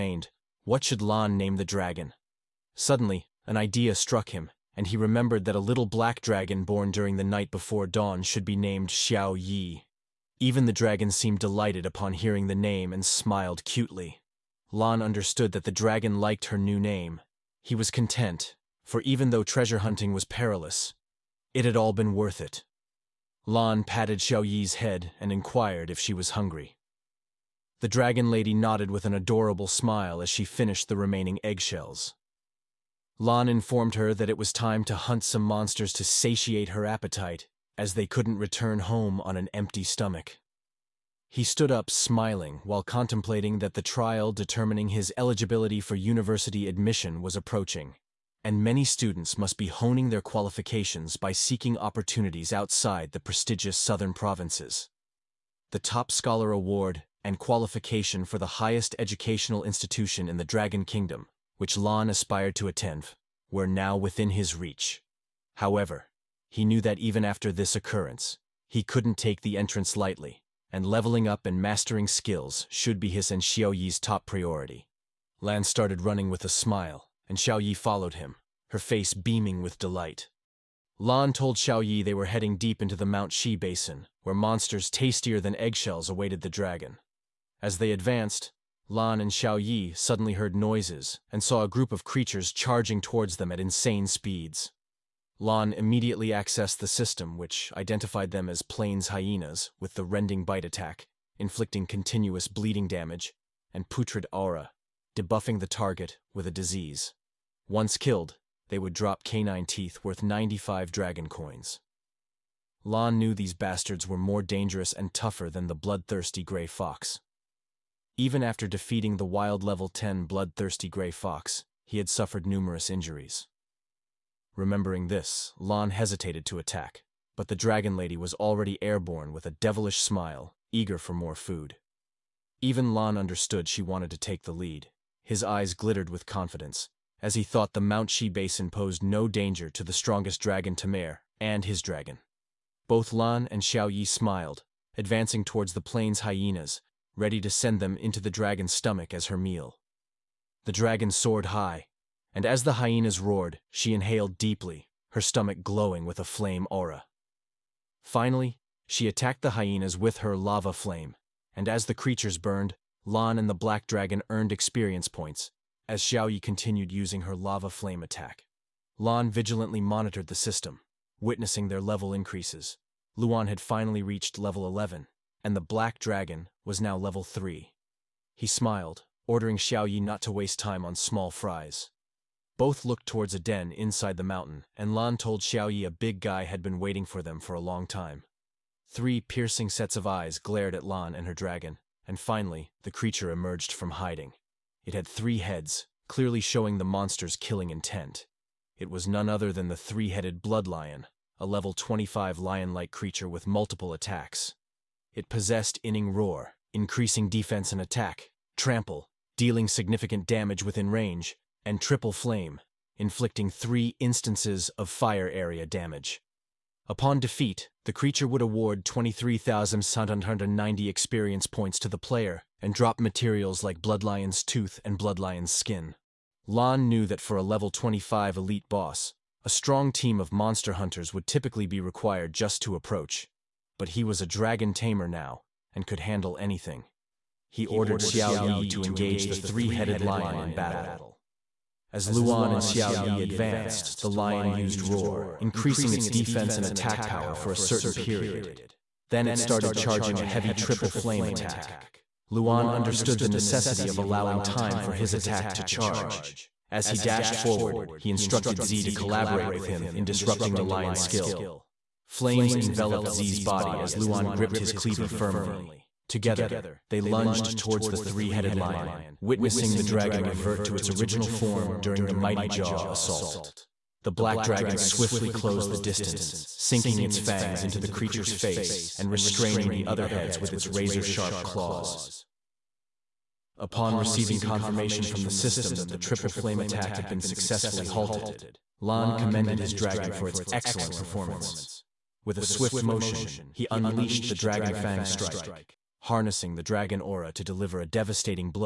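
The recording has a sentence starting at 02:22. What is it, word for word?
Both Lan and Xiao Yi smiled, advancing towards the plains hyenas, ready to send them into the dragon's stomach as her meal.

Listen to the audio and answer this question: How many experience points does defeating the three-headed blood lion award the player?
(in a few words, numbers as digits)
23,790.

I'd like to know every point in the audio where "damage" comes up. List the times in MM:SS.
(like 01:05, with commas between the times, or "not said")
01:42, 03:30, 03:35.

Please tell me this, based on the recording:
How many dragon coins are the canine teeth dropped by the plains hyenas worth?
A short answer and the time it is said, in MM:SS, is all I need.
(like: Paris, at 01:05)
95, at 01:50.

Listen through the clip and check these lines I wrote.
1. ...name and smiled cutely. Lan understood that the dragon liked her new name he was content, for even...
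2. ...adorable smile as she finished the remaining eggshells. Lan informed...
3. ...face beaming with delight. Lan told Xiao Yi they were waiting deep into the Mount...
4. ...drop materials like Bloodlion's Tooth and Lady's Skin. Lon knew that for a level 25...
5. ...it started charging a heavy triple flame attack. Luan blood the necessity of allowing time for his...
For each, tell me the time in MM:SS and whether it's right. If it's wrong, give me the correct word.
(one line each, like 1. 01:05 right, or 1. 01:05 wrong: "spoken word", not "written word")
1. 00:12 right
2. 00:29 right
3. 01:18 wrong: "heading", not "waiting"
4. 03:42 wrong: "Bloodlion", not "Lady"
5. 04:09 wrong: "understood", not "blood".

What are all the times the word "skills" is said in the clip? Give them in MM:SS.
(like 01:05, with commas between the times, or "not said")
01:12, 04:20.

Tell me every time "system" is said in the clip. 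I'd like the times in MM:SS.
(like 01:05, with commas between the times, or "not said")
01:36, 02:50, 04:45.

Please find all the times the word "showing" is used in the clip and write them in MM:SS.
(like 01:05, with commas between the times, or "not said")
03:16.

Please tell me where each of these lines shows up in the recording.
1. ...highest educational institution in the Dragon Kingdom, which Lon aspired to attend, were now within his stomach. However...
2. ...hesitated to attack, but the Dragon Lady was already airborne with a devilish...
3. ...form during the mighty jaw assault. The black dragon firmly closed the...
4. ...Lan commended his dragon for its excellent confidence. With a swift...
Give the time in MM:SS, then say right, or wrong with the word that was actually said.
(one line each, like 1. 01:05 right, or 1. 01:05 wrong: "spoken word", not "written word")
1. 00:58 wrong: "reach", not "stomach"
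2. 02:05 right
3. 04:31 wrong: "swiftly", not "firmly"
4. 04:48 wrong: "performance", not "confidence".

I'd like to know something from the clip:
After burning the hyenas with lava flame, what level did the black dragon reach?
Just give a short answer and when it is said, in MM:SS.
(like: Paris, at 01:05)
3, at 02:56.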